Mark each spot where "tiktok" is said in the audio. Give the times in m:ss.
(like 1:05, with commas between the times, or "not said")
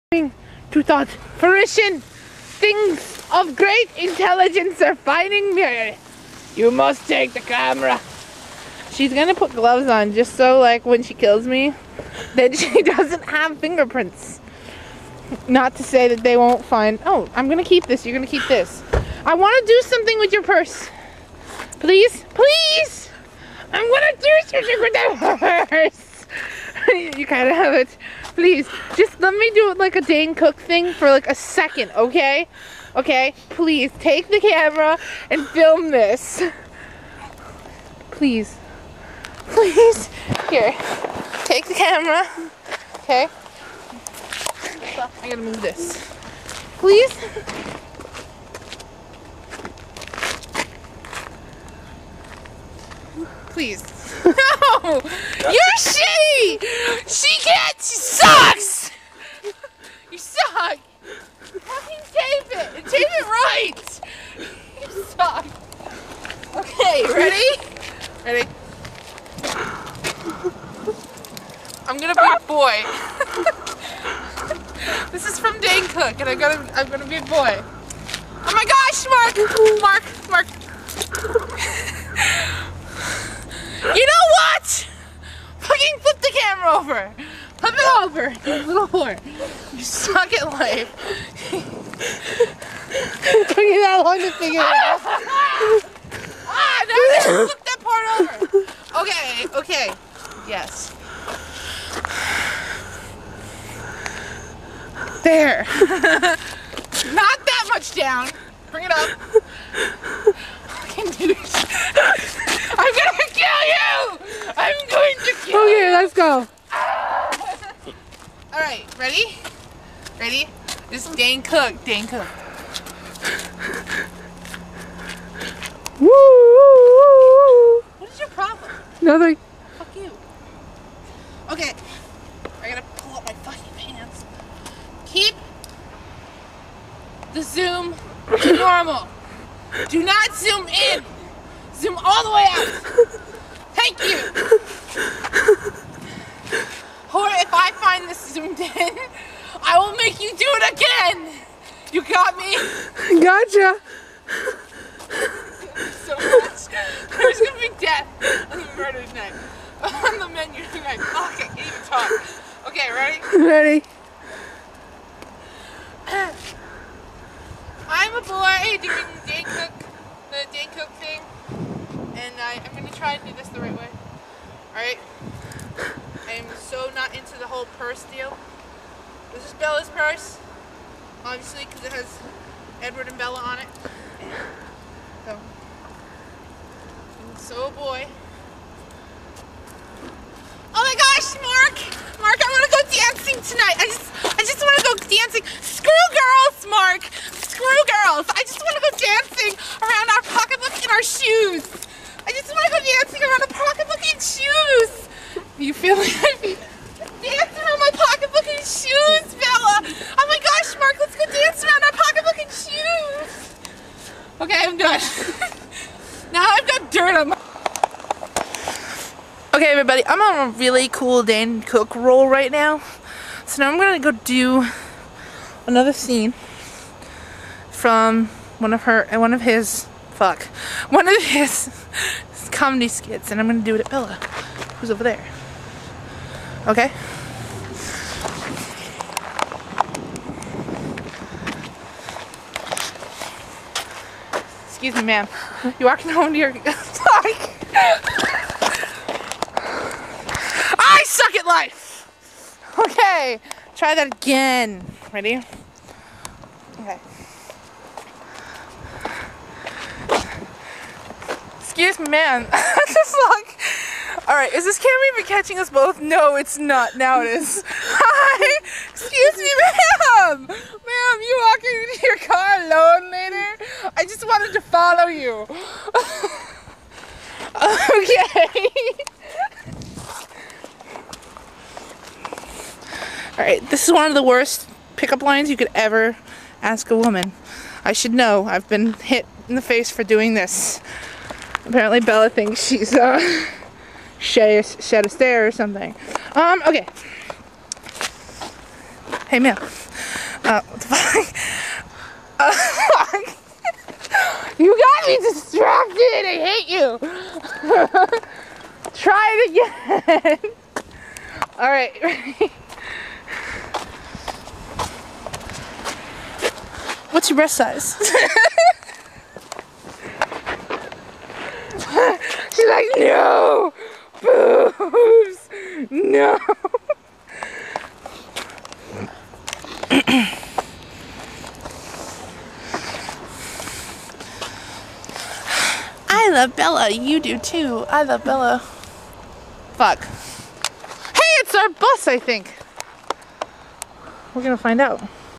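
not said.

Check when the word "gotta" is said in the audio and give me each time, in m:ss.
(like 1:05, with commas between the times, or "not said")
0:45, 2:12.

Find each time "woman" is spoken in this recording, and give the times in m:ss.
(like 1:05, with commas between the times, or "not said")
4:46.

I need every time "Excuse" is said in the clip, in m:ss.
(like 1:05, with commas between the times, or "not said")
4:04, 4:21, 4:28.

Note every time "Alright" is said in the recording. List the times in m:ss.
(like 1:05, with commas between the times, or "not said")
4:24, 4:43, 5:11.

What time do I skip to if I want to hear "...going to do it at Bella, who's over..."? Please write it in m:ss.
3:53.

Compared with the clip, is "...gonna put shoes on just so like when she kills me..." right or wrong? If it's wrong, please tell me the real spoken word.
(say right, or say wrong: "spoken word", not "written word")
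wrong: "gloves", not "shoes".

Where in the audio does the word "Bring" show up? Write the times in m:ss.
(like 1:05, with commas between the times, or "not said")
1:48.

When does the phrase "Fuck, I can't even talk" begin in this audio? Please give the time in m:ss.
2:41.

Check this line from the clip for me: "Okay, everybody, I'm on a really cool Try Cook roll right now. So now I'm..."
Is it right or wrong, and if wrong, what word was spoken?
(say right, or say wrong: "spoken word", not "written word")
wrong: "Dane", not "Try".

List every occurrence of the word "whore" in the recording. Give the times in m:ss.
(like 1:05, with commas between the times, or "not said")
1:28.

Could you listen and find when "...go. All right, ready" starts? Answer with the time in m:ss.
1:56.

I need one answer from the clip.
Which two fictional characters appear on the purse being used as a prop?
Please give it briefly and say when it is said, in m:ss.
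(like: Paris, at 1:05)
Edward and Bella, at 3:02.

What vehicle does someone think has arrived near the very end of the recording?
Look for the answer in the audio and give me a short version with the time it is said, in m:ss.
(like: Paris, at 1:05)
bus, at 5:41.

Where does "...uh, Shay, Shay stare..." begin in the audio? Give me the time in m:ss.
4:52.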